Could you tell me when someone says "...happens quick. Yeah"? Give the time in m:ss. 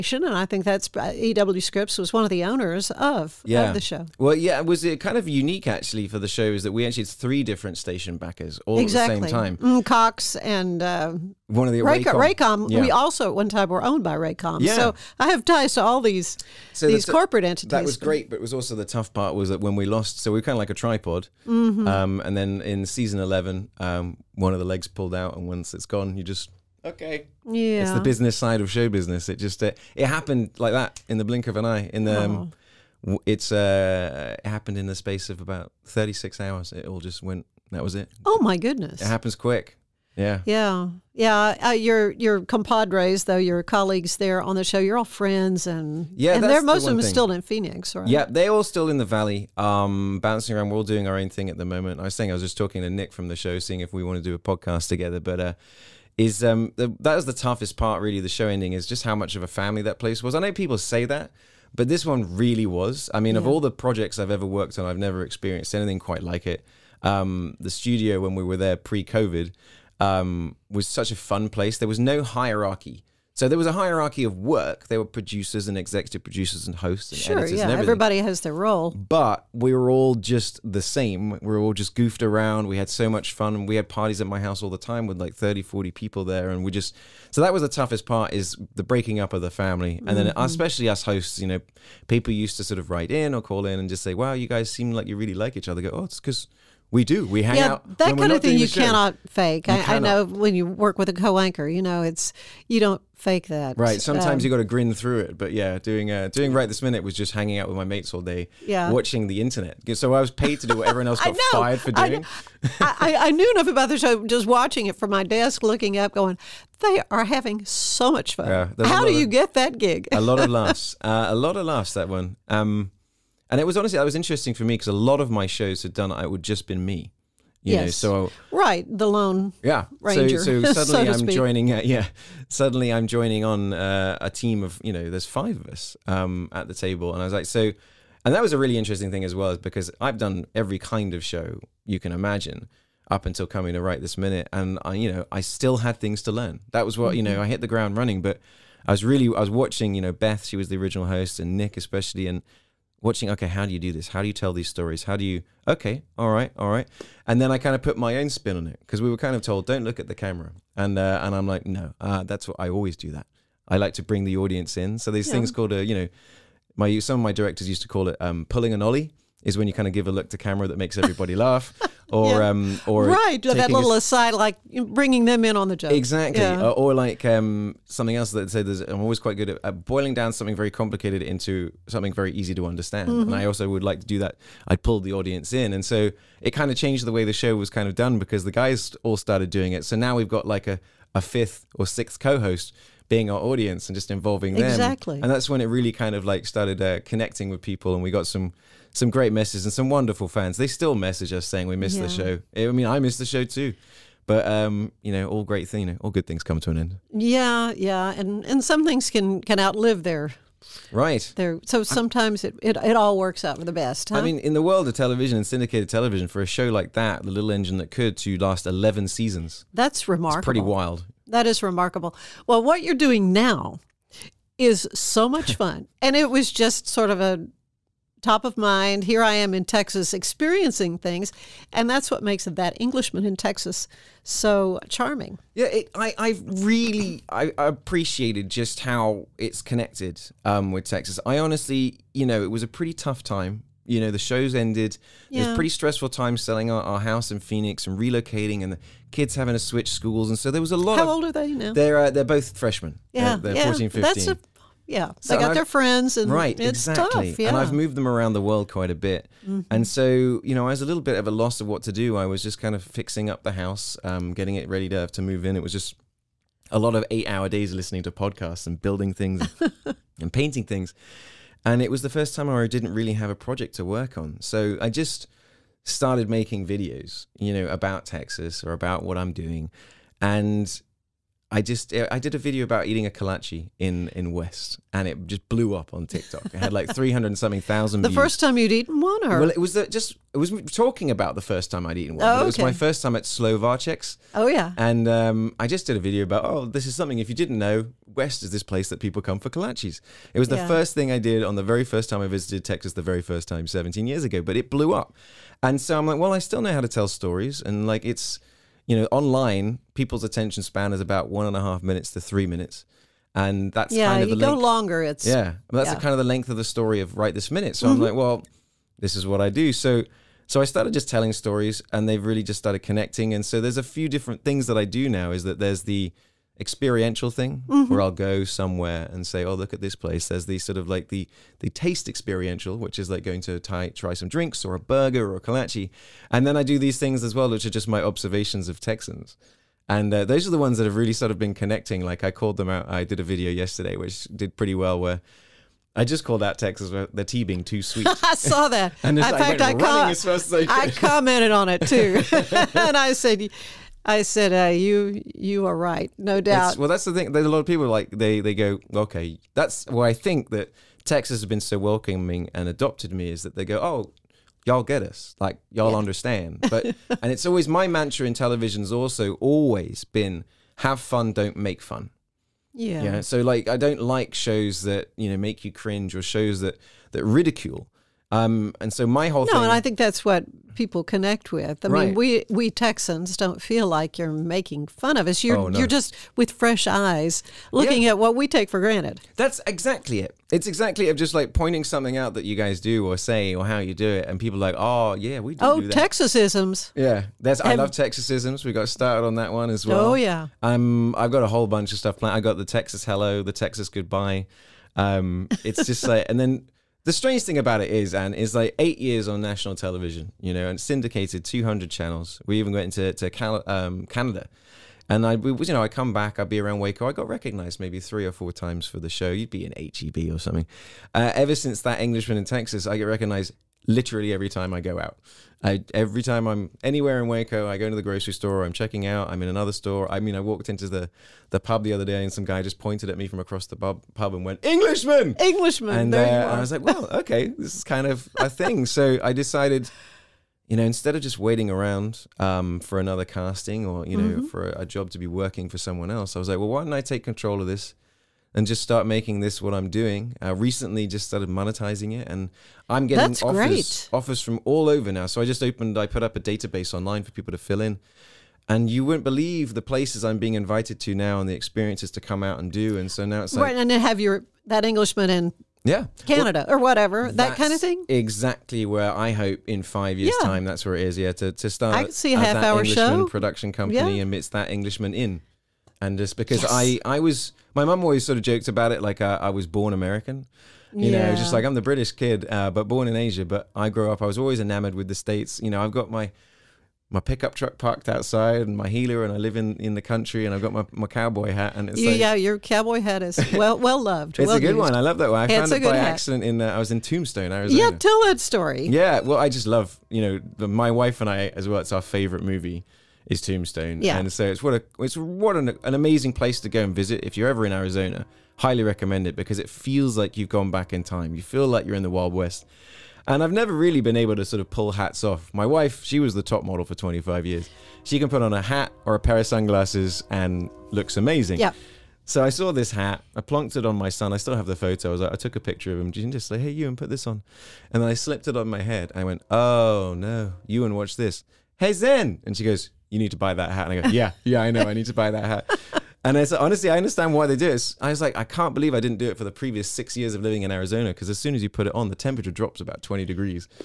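0:39.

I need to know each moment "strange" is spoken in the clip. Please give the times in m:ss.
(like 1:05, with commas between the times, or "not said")
6:47.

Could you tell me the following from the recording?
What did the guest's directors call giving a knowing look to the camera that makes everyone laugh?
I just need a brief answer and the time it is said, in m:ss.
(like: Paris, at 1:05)
Pulling an Ollie, at 2:48.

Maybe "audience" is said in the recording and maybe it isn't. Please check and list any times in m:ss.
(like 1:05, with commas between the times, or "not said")
2:44, 3:05, 3:13.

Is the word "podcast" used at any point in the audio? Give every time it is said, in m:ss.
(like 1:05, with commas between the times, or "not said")
0:54, 4:28.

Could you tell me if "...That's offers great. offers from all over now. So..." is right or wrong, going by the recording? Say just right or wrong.
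right.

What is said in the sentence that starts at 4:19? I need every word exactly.
and so you know, I was a little bit of a loss of what to do.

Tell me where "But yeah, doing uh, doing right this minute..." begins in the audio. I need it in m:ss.
1:45.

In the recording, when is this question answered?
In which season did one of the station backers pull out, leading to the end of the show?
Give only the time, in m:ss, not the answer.
0:22.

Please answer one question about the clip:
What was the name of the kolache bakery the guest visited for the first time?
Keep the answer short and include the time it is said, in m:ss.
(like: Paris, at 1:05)
Slovacek's, at 4:53.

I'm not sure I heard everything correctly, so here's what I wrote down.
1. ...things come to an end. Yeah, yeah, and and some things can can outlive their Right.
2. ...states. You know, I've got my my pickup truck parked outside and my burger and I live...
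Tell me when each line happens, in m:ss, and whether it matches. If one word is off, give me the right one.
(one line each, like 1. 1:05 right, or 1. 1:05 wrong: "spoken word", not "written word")
1. 3:26 right
2. 8:05 wrong: "heeler", not "burger".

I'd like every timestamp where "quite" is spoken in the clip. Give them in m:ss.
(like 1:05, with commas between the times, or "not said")
1:05, 2:59, 4:18.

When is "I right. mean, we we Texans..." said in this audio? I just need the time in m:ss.
6:21.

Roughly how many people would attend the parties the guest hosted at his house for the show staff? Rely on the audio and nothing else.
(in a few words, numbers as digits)
30 to 40.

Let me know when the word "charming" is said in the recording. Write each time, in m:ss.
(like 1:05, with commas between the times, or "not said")
3:54.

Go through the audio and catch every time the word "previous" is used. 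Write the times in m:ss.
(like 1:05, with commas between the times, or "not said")
8:59.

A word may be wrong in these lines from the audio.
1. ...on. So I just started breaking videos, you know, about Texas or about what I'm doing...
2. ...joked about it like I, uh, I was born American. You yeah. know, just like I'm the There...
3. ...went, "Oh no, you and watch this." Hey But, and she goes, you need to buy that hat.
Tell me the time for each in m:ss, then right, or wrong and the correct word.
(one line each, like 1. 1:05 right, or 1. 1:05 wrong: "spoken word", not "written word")
1. 4:34 wrong: "making", not "breaking"
2. 7:58 wrong: "British", not "There"
3. 8:49 wrong: "Zen", not "But".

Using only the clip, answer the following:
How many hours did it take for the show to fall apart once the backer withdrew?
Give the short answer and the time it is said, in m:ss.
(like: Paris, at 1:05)
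36, at 0:35.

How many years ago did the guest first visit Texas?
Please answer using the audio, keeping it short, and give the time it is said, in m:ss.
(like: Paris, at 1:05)
17, at 5:03.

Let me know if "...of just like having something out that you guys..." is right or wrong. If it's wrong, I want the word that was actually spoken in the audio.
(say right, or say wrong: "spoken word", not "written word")
wrong: "pointing", not "having".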